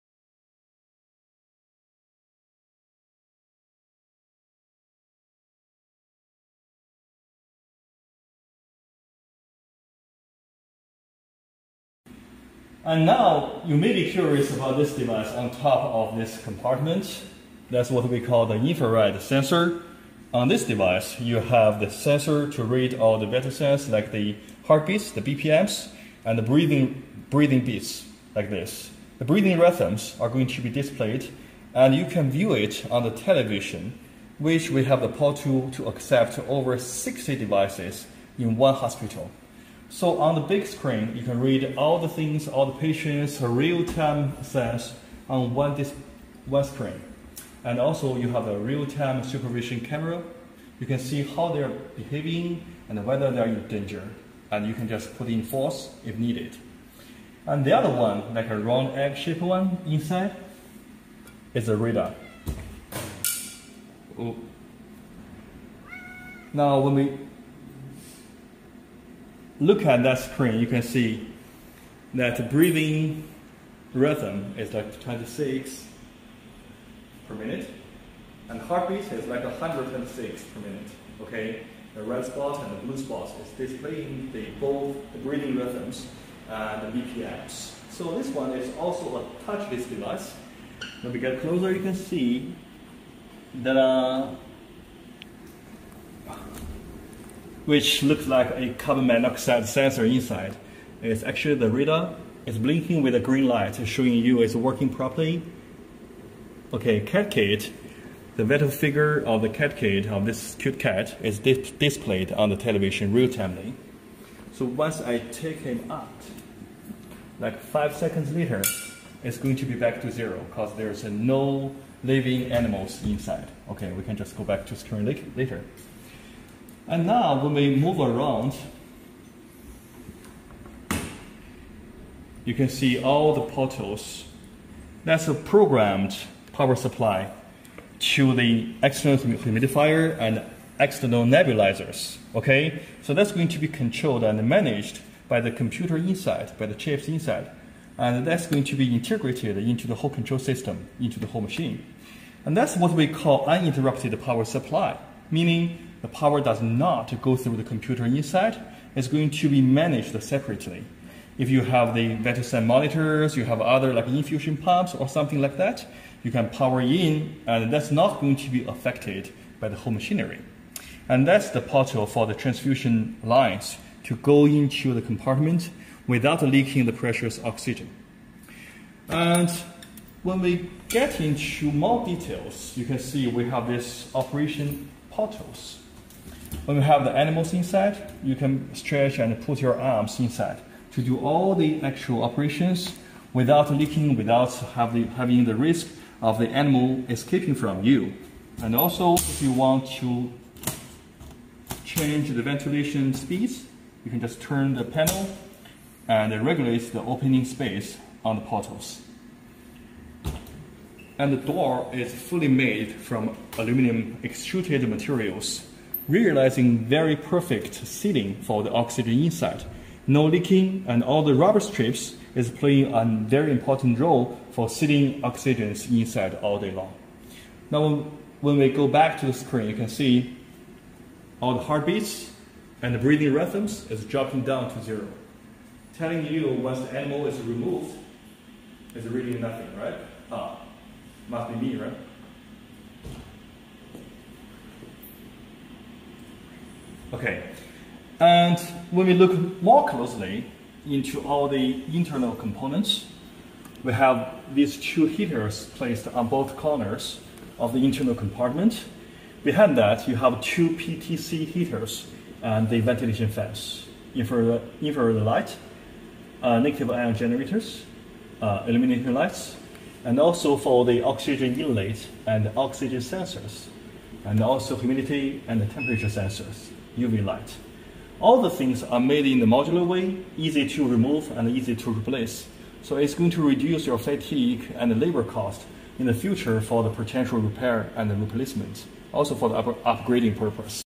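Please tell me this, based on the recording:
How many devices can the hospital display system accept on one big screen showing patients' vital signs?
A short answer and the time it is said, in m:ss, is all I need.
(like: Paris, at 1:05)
over 60, at 0:36.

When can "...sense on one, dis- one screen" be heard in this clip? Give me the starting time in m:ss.
0:44.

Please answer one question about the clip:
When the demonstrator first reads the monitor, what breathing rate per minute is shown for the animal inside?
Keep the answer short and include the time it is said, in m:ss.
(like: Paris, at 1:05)
26, at 1:14.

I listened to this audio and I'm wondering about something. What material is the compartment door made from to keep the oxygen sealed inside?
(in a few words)
Aluminum.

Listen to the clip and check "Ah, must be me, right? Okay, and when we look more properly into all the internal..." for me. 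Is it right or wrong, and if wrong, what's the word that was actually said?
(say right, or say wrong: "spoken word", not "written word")
wrong: "closely", not "properly".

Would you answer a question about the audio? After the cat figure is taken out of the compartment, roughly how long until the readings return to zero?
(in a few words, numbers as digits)
5 seconds.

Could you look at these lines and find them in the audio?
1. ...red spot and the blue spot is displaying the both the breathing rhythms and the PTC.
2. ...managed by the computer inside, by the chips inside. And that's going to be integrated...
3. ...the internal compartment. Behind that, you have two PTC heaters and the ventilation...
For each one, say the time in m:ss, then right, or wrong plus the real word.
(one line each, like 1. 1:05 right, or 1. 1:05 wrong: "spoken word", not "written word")
1. 1:22 wrong: "BPMs", not "PTC"
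2. 2:24 right
3. 4:17 right.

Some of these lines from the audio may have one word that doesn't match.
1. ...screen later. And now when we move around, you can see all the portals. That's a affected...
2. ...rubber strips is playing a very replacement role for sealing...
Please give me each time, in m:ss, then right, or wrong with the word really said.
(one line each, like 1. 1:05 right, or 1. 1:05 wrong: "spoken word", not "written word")
1. 2:04 wrong: "programmed", not "affected"
2. 3:41 wrong: "important", not "replacement".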